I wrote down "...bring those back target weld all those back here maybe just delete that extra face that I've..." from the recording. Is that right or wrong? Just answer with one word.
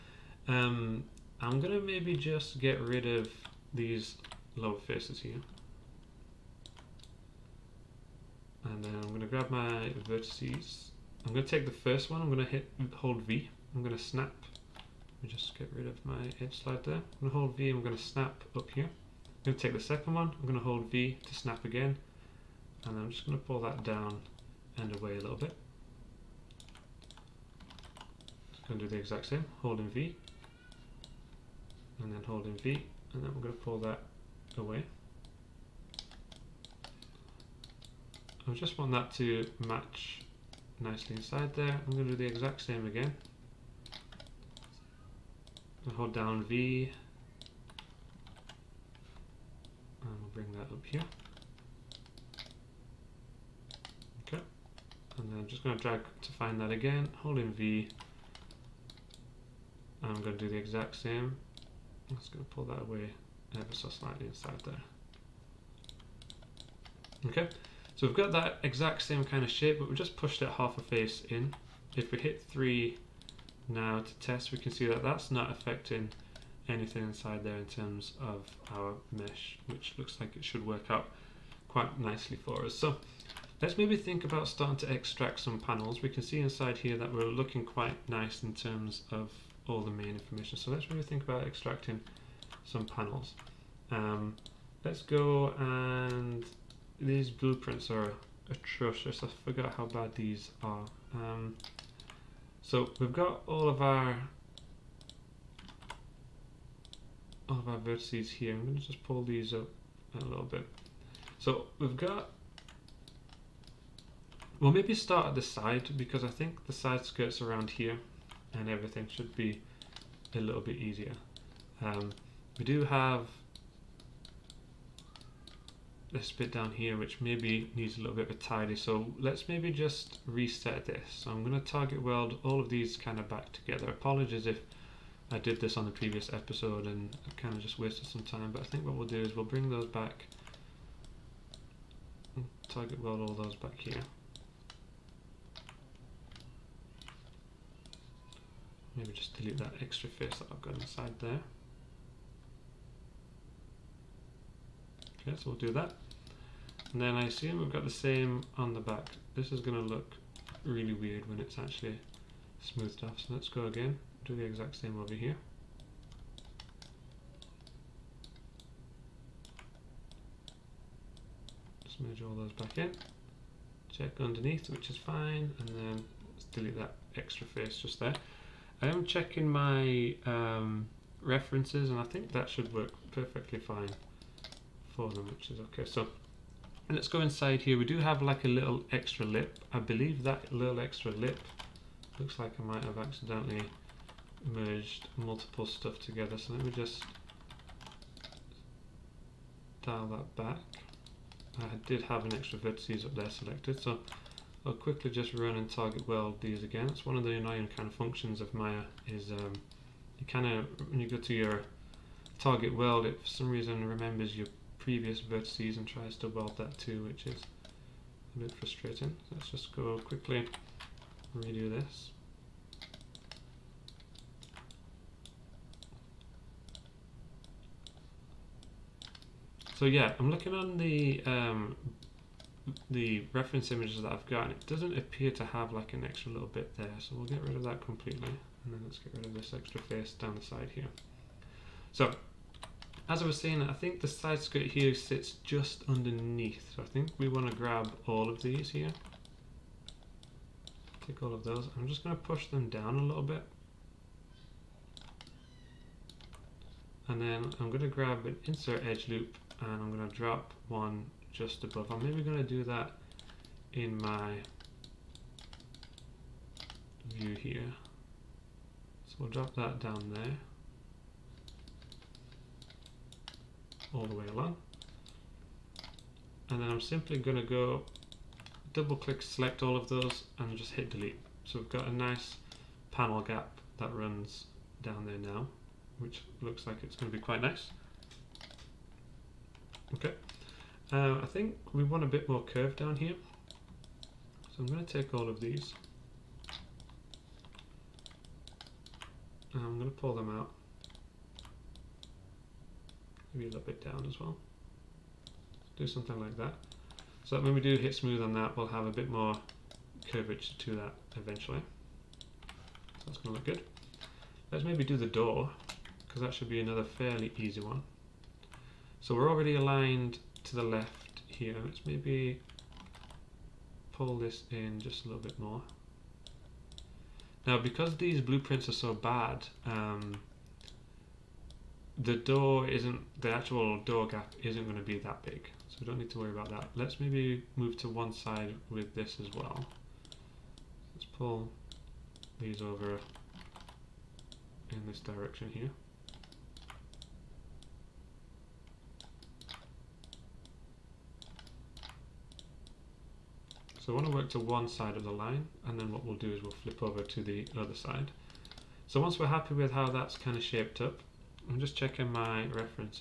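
right.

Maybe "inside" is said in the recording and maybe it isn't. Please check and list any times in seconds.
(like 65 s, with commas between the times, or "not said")
41 s, 64 s, 77 s, 86 s, 150 s, 187 s.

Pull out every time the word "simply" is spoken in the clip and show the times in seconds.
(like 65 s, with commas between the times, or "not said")
276 s.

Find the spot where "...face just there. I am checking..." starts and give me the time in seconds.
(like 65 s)
177 s.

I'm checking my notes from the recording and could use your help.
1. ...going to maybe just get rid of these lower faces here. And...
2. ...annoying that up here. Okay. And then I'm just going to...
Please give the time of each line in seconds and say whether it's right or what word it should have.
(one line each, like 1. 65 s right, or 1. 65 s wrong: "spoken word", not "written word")
1. 1 s right
2. 50 s wrong: "bring", not "annoying".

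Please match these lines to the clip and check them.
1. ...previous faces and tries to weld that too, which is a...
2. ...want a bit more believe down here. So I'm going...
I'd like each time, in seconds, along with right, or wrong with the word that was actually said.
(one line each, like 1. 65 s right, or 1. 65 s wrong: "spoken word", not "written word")
1. 214 s wrong: "vertices", not "faces"
2. 291 s wrong: "curve", not "believe".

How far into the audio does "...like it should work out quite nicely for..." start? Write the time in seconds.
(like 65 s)
80 s.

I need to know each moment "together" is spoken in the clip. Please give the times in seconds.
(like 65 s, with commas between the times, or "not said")
133 s, 196 s.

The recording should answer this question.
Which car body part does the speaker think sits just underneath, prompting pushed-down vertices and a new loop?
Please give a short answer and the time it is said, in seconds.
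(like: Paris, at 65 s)
Side skirt, at 244 s.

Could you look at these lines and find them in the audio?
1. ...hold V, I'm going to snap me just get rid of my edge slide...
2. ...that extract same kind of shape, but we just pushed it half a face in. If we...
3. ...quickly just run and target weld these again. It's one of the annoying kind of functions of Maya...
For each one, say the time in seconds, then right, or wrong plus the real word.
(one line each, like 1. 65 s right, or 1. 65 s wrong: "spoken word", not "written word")
1. 12 s right
2. 68 s wrong: "exact", not "extract"
3. 204 s right.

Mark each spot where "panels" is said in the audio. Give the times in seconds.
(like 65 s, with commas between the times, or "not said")
85 s, 92 s, 282 s.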